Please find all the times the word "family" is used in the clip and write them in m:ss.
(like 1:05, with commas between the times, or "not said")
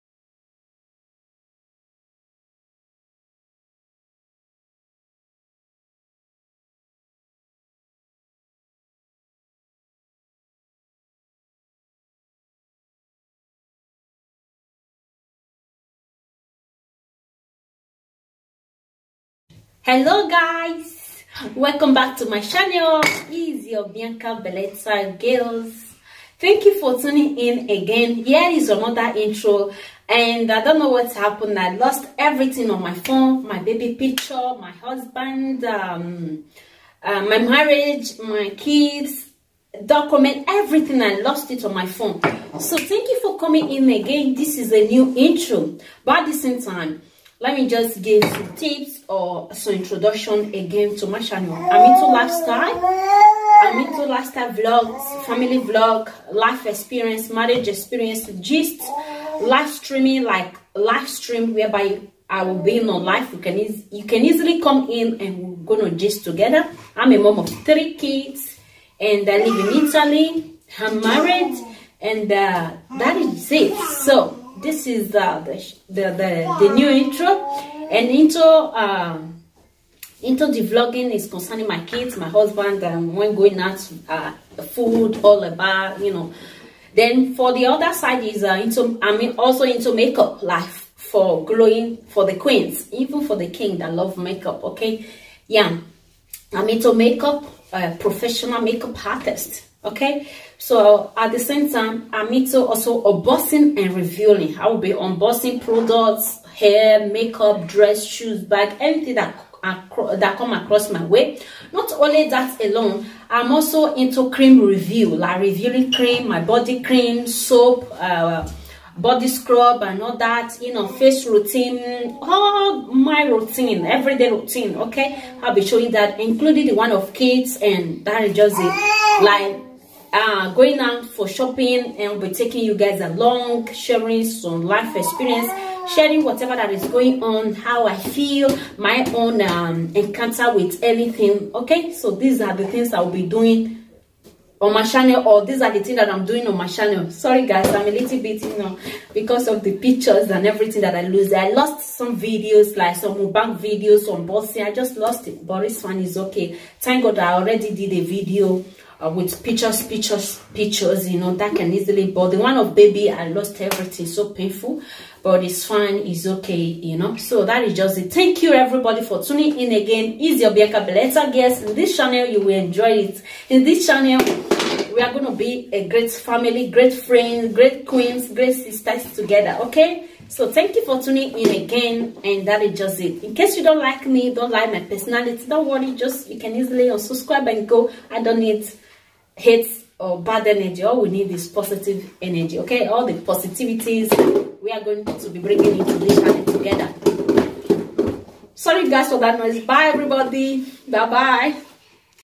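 0:55, 2:56.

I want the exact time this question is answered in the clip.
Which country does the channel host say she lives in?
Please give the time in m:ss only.
1:09.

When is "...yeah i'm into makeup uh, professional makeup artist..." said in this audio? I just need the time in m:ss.
1:35.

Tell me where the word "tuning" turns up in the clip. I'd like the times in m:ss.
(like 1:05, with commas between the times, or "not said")
0:27, 2:49, 3:01.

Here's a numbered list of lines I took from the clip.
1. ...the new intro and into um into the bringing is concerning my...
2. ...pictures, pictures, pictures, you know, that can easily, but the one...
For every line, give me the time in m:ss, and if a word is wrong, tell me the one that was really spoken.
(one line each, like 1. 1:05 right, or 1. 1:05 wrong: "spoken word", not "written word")
1. 1:16 wrong: "vlogging", not "bringing"
2. 2:39 right.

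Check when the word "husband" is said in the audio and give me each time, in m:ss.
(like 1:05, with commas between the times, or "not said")
0:34, 1:22.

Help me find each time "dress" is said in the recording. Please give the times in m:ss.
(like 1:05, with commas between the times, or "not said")
1:47.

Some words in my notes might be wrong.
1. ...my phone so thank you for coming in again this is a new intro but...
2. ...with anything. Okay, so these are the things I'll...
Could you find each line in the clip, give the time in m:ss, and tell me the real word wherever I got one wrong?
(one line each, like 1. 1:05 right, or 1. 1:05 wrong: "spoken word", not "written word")
1. 0:41 right
2. 2:20 right.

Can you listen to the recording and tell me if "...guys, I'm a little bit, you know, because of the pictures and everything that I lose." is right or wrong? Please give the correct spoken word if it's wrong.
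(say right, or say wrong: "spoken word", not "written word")
right.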